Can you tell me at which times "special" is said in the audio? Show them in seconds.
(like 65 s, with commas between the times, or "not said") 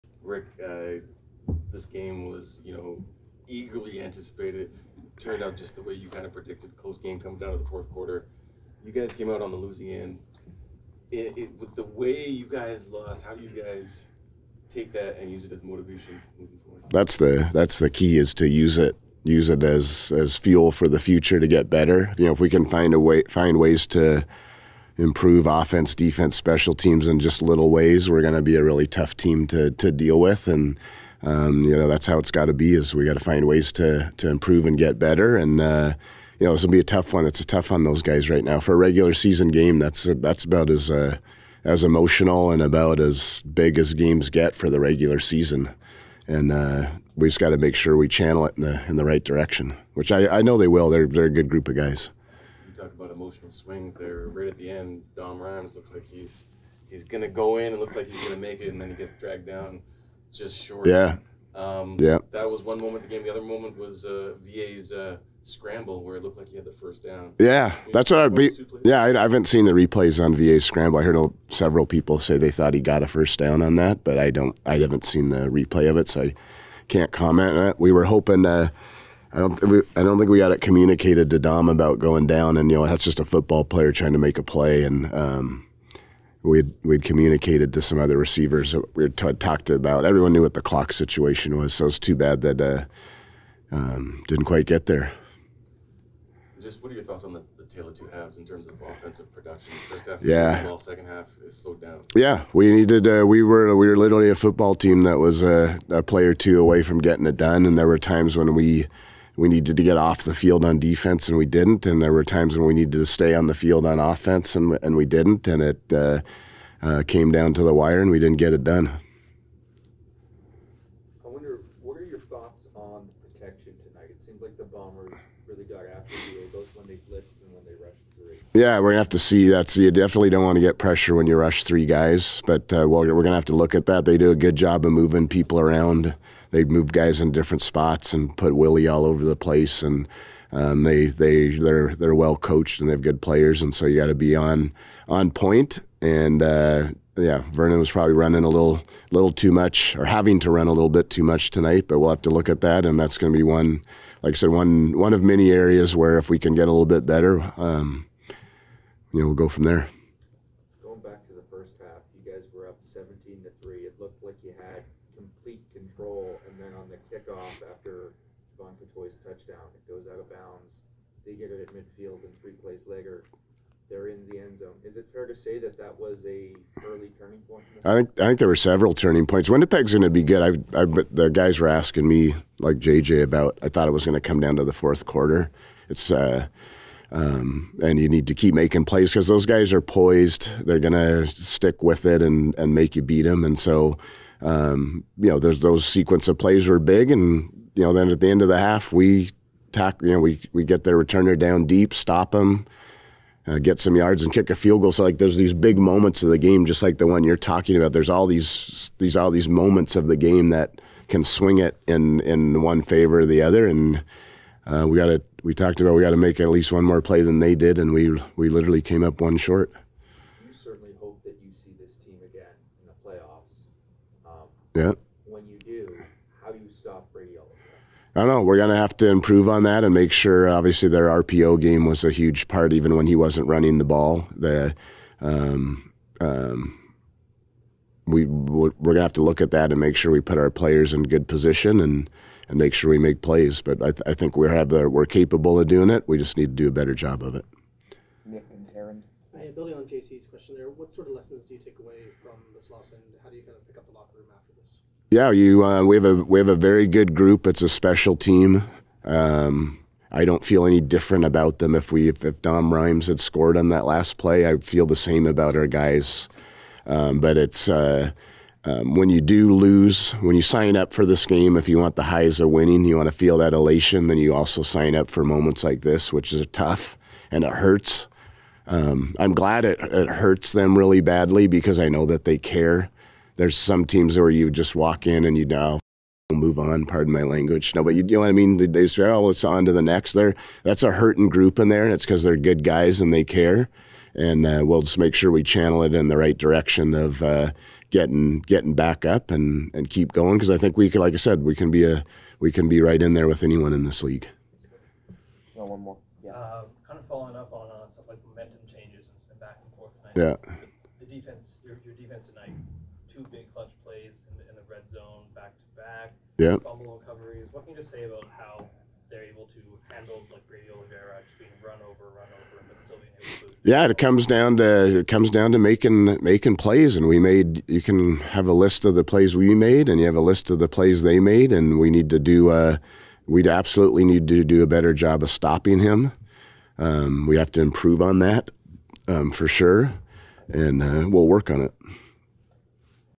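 26 s, 257 s.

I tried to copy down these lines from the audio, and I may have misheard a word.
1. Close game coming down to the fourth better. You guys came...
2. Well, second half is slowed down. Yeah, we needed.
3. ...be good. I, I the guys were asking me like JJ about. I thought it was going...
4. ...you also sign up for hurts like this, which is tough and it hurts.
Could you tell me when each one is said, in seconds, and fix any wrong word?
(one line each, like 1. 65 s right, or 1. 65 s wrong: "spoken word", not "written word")
1. 6 s wrong: "quarter", not "better"
2. 100 s right
3. 180 s right
4. 274 s wrong: "moments", not "hurts".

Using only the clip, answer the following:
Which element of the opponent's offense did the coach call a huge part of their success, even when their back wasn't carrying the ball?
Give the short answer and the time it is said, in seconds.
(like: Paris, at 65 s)
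RPO game, at 231 s.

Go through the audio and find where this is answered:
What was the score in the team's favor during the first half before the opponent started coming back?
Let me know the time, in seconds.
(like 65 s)
162 s.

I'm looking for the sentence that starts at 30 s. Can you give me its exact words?
And, um, you know, that's how it's got to be is we got to find ways to, to improve and get better.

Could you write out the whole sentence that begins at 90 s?
Everyone knew what the clock situation was, so it's too bad that uh, um, didn't quite get there.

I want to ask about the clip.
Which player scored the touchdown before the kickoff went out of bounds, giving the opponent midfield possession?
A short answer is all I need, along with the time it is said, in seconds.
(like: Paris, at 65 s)
Jevon Cottoy, at 168 s.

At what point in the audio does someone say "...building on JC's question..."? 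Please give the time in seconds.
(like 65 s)
249 s.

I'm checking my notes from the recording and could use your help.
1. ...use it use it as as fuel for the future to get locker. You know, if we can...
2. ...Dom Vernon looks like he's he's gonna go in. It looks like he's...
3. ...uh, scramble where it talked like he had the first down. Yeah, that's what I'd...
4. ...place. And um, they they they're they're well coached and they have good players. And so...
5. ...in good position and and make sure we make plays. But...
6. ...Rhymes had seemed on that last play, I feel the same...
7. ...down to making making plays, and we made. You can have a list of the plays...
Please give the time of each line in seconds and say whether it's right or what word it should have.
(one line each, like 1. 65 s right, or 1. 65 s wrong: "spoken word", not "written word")
1. 18 s wrong: "better", not "locker"
2. 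55 s wrong: "Rhymes", not "Vernon"
3. 64 s wrong: "looked", not "talked"
4. 139 s right
5. 240 s right
6. 262 s wrong: "scored", not "seemed"
7. 325 s right.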